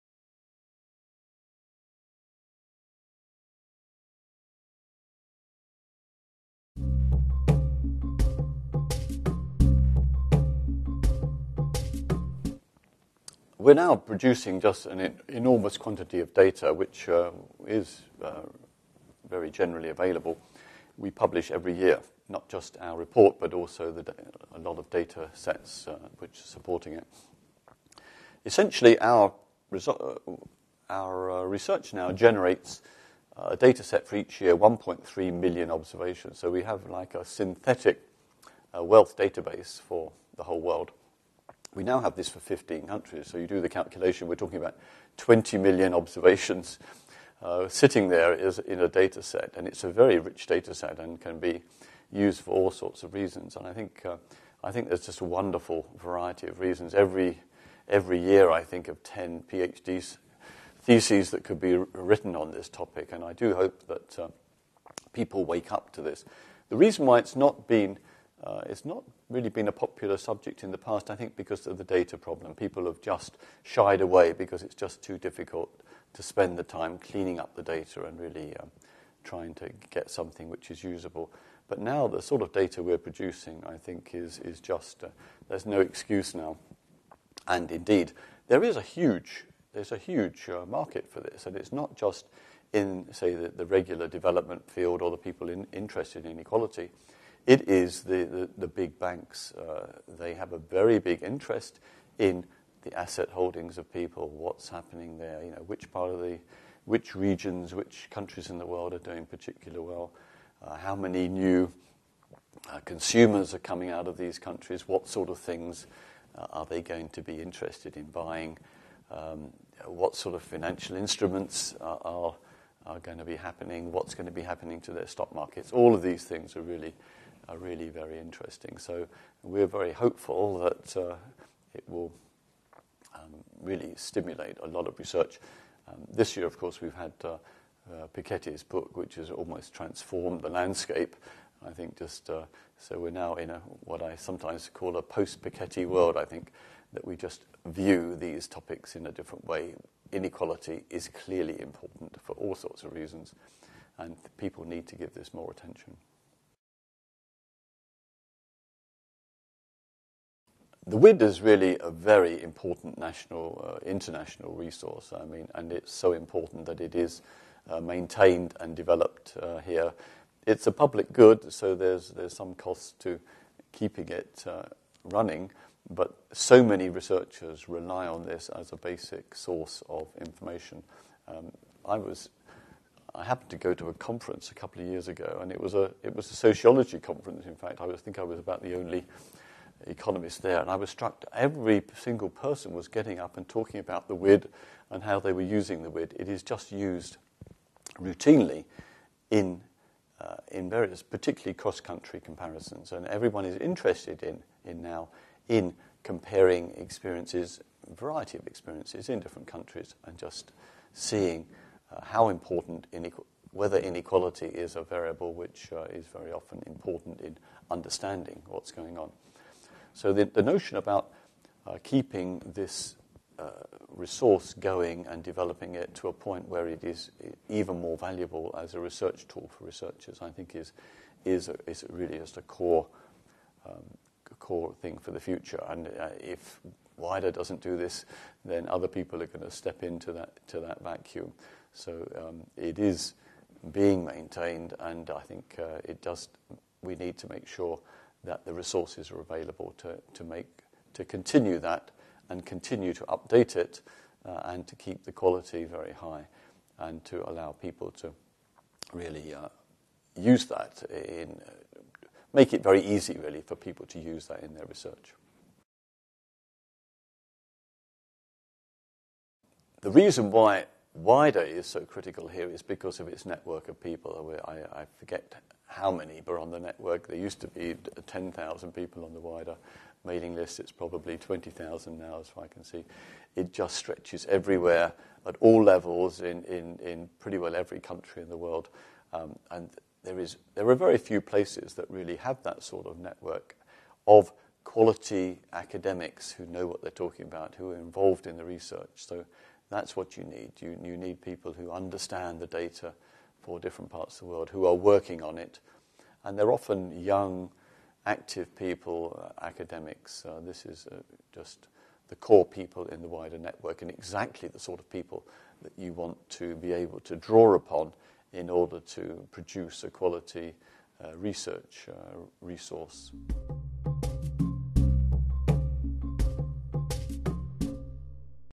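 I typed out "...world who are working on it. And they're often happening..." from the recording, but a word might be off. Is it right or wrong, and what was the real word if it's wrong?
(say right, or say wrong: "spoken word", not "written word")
wrong: "young", not "happening".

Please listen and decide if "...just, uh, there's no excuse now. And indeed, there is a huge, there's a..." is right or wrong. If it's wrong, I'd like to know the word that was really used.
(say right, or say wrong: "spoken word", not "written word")
right.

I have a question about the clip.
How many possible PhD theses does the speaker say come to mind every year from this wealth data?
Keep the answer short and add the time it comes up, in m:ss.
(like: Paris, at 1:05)
10, at 0:59.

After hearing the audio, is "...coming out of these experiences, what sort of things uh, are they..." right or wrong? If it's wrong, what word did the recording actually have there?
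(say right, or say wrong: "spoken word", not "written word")
wrong: "countries", not "experiences".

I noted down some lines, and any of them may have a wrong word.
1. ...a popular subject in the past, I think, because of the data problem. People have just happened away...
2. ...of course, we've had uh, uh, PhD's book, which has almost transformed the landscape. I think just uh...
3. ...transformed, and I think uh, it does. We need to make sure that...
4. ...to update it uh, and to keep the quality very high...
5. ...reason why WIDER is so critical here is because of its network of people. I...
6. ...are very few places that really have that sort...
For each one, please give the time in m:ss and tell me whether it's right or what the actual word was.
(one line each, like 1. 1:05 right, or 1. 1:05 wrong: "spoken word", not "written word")
1. 1:09 wrong: "shied", not "happened"
2. 2:16 wrong: "Piketty", not "PhD"
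3. 4:04 wrong: "maintained", not "transformed"
4. 4:12 right
5. 4:29 right
6. 4:50 right.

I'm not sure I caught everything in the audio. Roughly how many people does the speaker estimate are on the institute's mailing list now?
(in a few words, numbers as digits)
20,000.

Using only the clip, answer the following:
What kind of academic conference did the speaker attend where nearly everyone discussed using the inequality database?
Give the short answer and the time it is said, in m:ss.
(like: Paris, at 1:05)
Sociology, at 3:06.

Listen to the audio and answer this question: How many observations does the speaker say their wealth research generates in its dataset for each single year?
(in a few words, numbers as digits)
1.3 million.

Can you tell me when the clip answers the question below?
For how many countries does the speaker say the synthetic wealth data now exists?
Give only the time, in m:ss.
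0:42.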